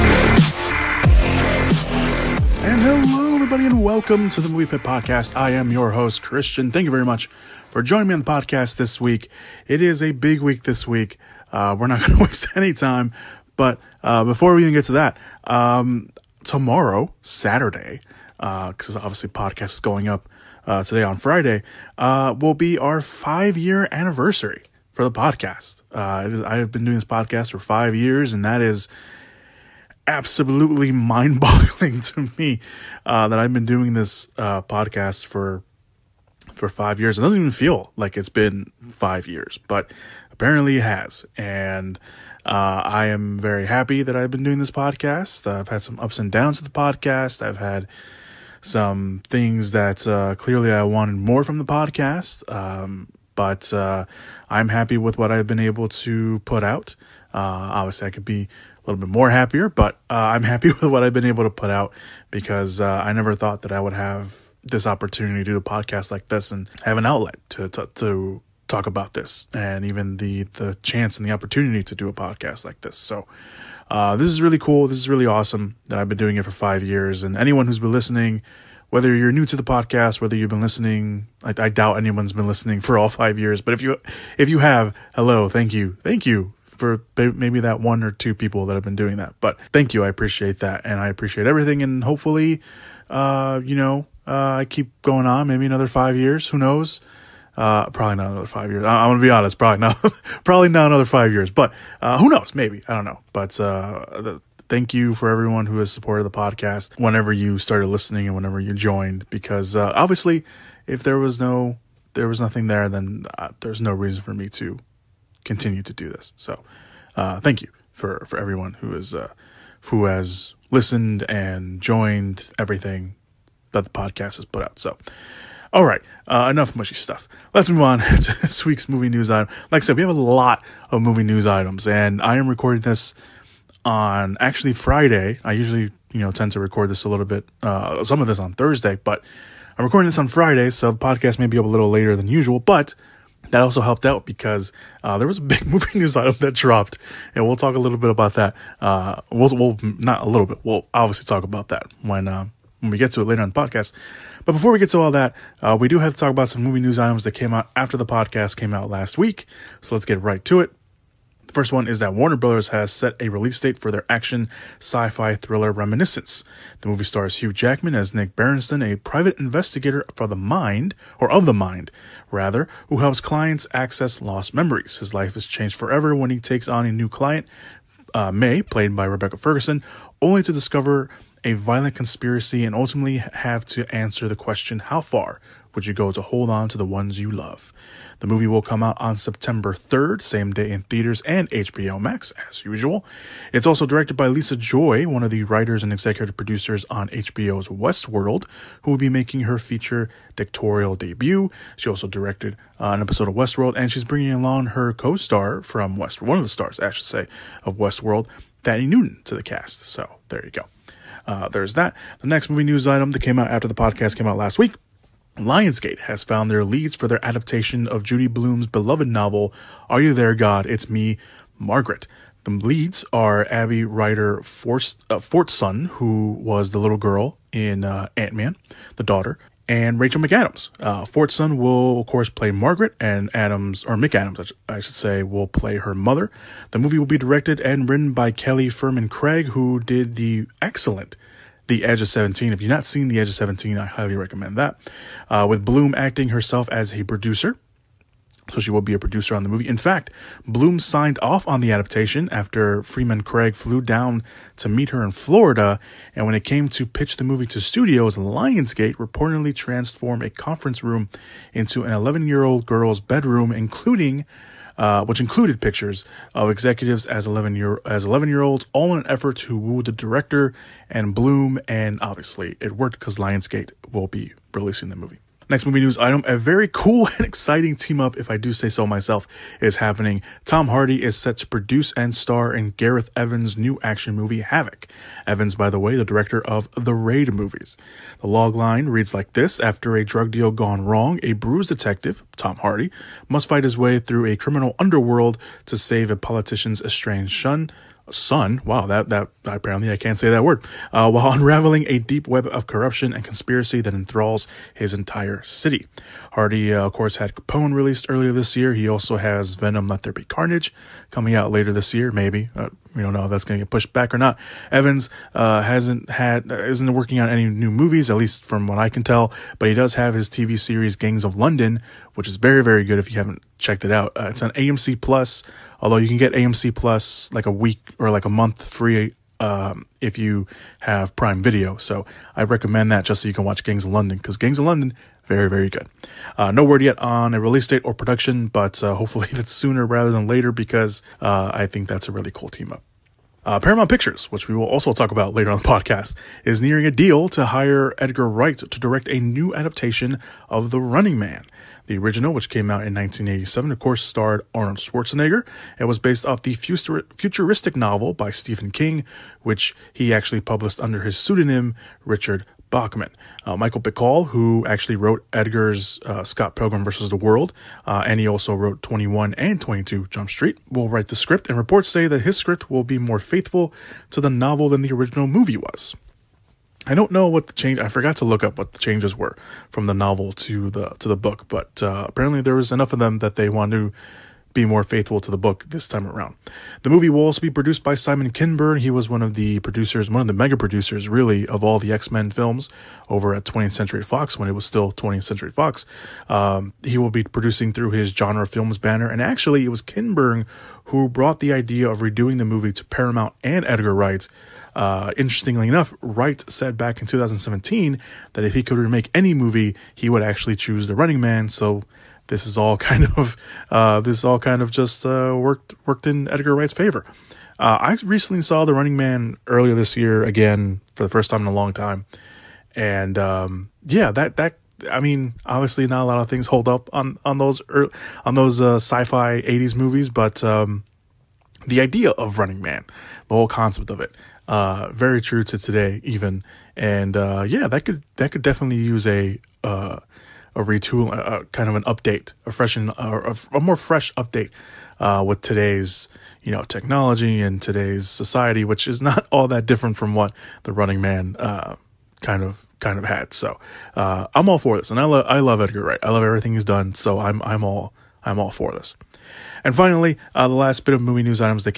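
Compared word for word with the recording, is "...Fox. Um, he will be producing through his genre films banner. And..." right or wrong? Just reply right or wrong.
right.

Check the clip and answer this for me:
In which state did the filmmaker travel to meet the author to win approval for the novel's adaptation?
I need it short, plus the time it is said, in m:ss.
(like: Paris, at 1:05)
Florida, at 4:15.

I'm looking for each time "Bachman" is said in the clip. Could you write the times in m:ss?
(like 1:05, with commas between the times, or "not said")
6:02.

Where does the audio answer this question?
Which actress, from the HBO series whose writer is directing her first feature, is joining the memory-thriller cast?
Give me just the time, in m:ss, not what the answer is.
3:28.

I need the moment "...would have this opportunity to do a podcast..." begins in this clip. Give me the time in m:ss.
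1:03.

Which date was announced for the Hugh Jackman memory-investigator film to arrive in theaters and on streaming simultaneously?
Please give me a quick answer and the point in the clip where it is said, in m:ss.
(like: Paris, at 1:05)
September 3rd, at 3:09.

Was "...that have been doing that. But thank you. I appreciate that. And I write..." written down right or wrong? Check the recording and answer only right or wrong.
wrong.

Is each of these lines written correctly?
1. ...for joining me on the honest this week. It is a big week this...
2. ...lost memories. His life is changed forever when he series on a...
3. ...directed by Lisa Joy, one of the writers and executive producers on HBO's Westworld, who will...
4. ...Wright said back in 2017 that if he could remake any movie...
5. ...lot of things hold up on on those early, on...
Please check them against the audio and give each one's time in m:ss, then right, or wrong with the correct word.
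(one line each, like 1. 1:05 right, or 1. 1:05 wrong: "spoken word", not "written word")
1. 0:07 wrong: "podcast", not "honest"
2. 2:54 wrong: "takes", not "series"
3. 3:13 right
4. 6:46 right
5. 7:06 right.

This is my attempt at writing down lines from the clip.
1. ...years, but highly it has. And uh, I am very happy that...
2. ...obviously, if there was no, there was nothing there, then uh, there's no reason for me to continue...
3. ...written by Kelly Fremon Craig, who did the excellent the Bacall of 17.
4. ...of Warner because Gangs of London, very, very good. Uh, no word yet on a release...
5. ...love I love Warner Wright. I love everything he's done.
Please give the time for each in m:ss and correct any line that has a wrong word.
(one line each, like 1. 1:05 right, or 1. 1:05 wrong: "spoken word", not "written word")
1. 0:39 wrong: "apparently", not "highly"
2. 1:49 right
3. 3:57 wrong: "Edge", not "Bacall"
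4. 5:33 wrong: "London", not "Warner"
5. 7:35 wrong: "Edgar", not "Warner".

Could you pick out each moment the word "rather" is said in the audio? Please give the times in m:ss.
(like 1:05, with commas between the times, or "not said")
2:52, 5:39.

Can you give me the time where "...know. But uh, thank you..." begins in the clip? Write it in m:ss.
1:43.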